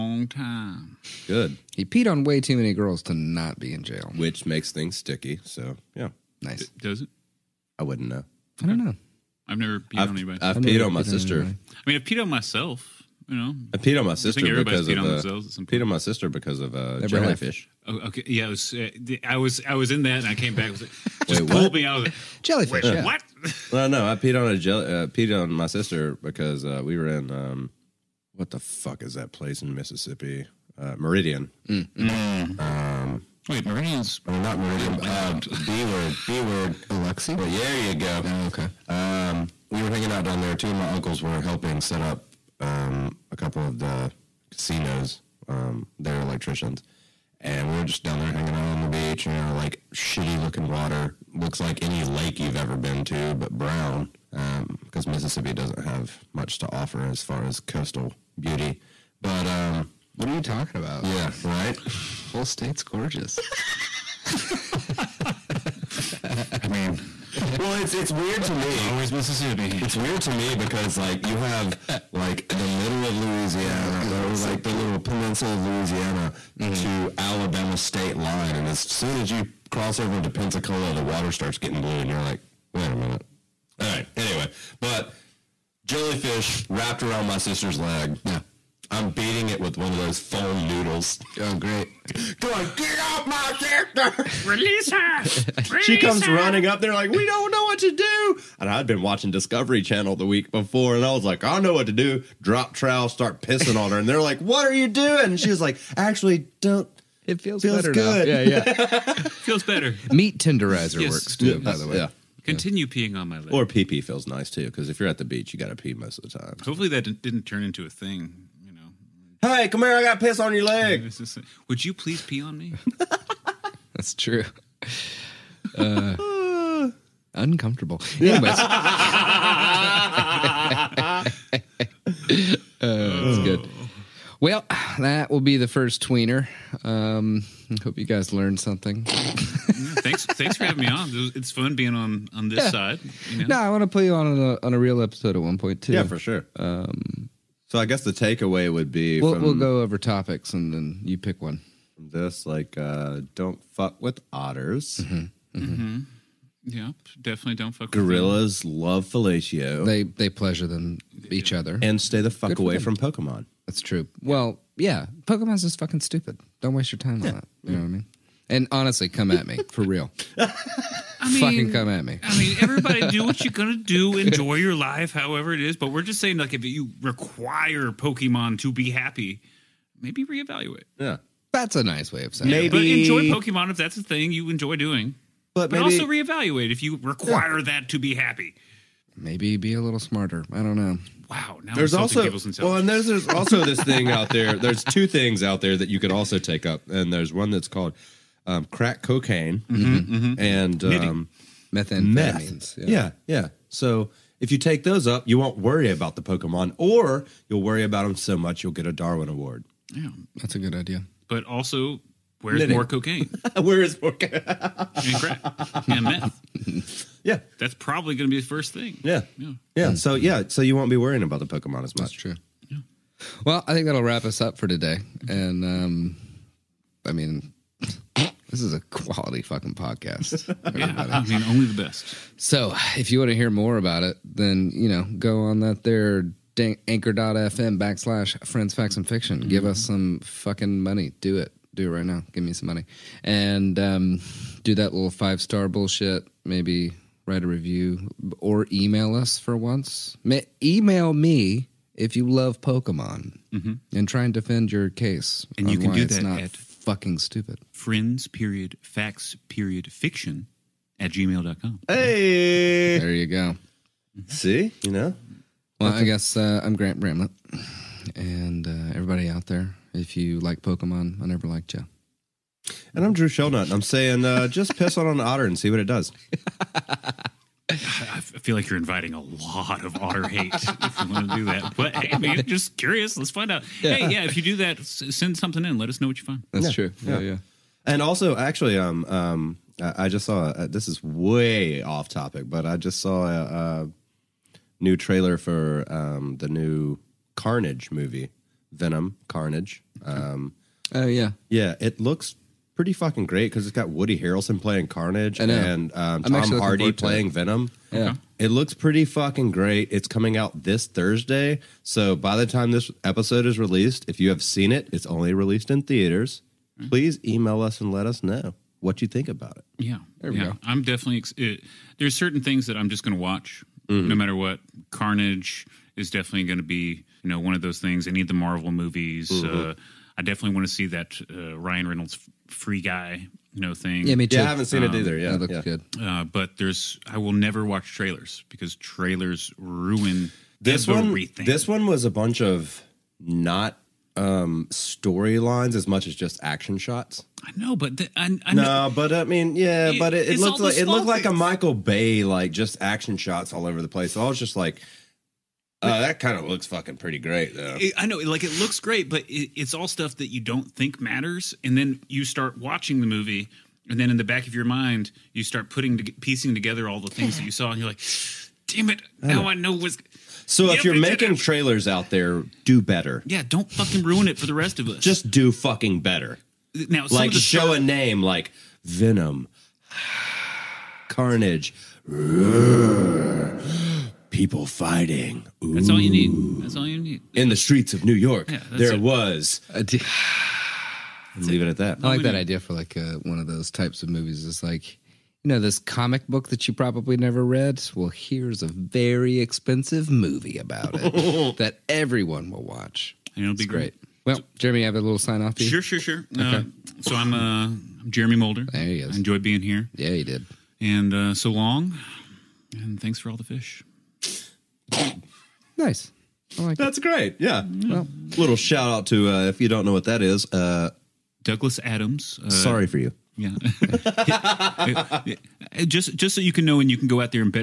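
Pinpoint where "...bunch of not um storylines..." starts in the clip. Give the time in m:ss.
5:42.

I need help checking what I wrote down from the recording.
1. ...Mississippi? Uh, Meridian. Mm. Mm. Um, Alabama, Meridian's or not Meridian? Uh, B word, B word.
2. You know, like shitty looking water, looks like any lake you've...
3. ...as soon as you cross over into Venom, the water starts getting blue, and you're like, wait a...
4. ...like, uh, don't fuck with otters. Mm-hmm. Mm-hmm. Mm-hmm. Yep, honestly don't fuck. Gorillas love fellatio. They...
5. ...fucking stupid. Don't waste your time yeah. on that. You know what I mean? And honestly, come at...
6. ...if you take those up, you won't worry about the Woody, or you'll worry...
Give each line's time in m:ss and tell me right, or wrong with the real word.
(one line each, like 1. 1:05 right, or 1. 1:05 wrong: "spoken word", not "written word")
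1. 0:29 wrong: "Wait", not "Alabama"
2. 0:49 right
3. 1:18 wrong: "Pensacola", not "Venom"
4. 2:32 wrong: "definitely", not "honestly"
5. 2:45 right
6. 3:24 wrong: "Pokemon", not "Woody".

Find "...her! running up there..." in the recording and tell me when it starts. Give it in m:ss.
1:36.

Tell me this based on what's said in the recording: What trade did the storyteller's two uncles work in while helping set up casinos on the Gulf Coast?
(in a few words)
Electricians.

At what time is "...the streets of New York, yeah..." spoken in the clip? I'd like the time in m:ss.
6:27.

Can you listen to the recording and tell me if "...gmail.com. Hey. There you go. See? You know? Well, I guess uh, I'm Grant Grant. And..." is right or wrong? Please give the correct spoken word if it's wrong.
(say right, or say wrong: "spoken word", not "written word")
wrong: "Bramlett", not "Grant".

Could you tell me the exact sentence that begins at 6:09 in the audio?
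Now I know what's." So yep, if you're making trailers out there, do better.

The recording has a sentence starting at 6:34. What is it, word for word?
It's like, you know, this comic book that you probably never read.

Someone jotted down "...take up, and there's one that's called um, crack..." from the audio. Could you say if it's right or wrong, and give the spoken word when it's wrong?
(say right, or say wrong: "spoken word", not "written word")
right.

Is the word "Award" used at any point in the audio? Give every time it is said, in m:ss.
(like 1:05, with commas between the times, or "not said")
3:29.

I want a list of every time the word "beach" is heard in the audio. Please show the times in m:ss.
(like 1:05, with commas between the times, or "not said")
0:48, 1:55.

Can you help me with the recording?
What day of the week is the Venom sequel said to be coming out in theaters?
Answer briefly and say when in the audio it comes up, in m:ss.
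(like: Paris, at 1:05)
Thursday, at 5:10.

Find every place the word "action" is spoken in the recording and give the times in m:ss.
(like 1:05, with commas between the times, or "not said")
5:46, 5:52.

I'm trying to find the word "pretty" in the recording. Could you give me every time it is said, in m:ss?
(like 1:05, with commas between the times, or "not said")
5:02, 5:08, 5:56.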